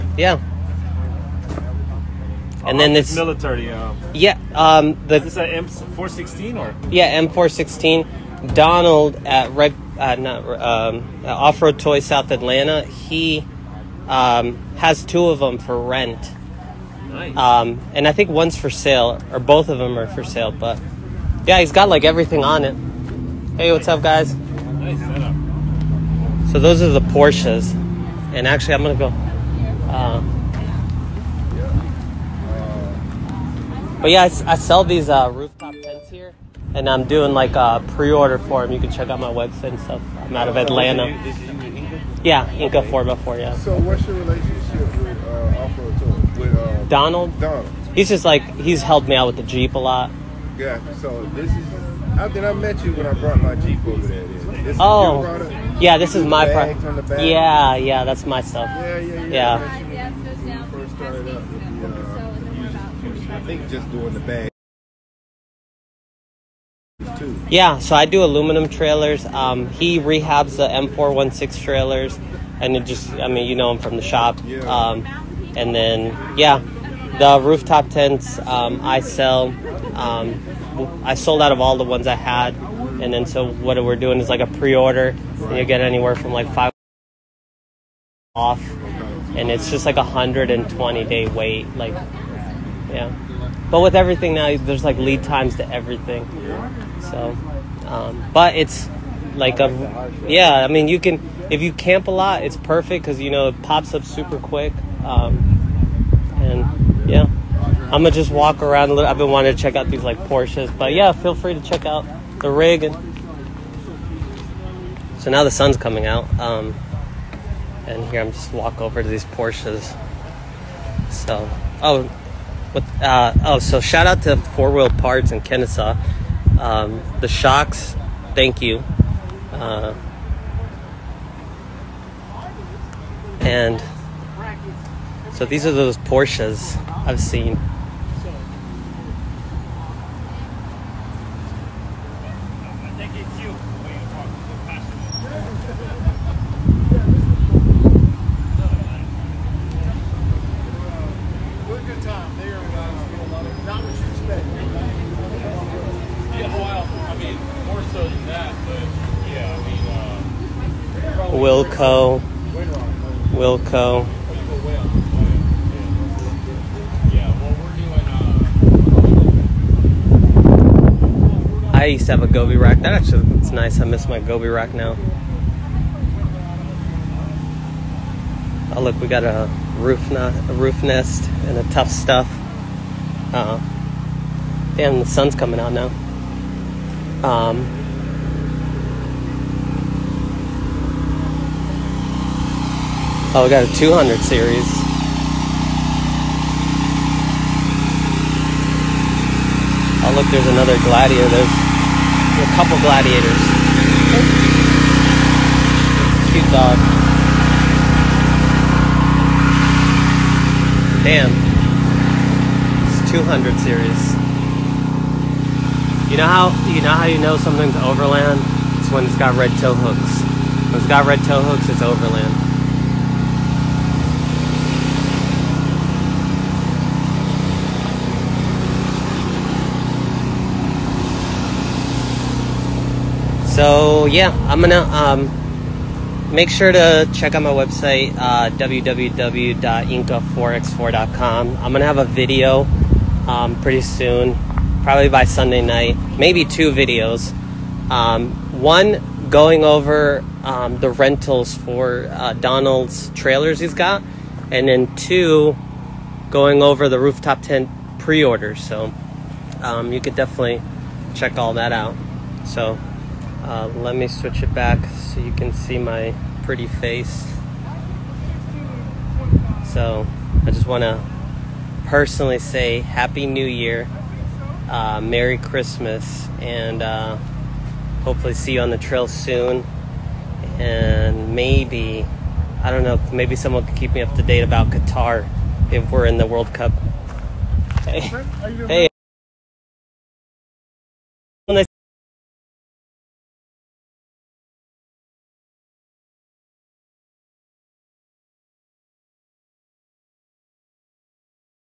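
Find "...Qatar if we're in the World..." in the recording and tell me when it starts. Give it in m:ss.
4:44.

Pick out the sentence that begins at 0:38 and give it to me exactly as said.
You can check out my website and stuff.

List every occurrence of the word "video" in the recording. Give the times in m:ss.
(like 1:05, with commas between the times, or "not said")
4:02, 4:06.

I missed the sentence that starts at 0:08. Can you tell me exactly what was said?
Donald at Red, uh, not um, uh, Off Road Toy South Atlanta.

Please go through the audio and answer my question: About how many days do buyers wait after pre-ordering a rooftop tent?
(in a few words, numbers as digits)
120.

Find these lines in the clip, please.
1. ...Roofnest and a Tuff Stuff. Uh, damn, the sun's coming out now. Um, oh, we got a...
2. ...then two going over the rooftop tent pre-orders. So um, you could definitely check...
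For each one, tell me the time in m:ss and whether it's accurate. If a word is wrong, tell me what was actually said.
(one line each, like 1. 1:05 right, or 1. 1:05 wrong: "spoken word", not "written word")
1. 3:00 right
2. 4:14 right.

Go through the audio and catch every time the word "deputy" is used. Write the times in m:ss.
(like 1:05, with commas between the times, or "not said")
not said.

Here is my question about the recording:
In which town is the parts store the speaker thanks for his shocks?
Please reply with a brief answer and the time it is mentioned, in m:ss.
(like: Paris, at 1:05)
Kennesaw, at 2:05.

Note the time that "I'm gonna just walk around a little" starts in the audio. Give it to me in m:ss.
1:47.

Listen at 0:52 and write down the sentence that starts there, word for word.
I think I met you when I brought my Jeep over there.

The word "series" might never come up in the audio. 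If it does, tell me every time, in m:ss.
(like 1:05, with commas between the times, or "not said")
3:14, 3:33.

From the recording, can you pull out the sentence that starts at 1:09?
Um, he rehabs the M416 trailers, and it just, I mean, you know him from the shop.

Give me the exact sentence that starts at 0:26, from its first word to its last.
So those are the Porsches, and actually, I'm gonna go.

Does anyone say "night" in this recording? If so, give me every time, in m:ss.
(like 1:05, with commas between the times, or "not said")
4:05.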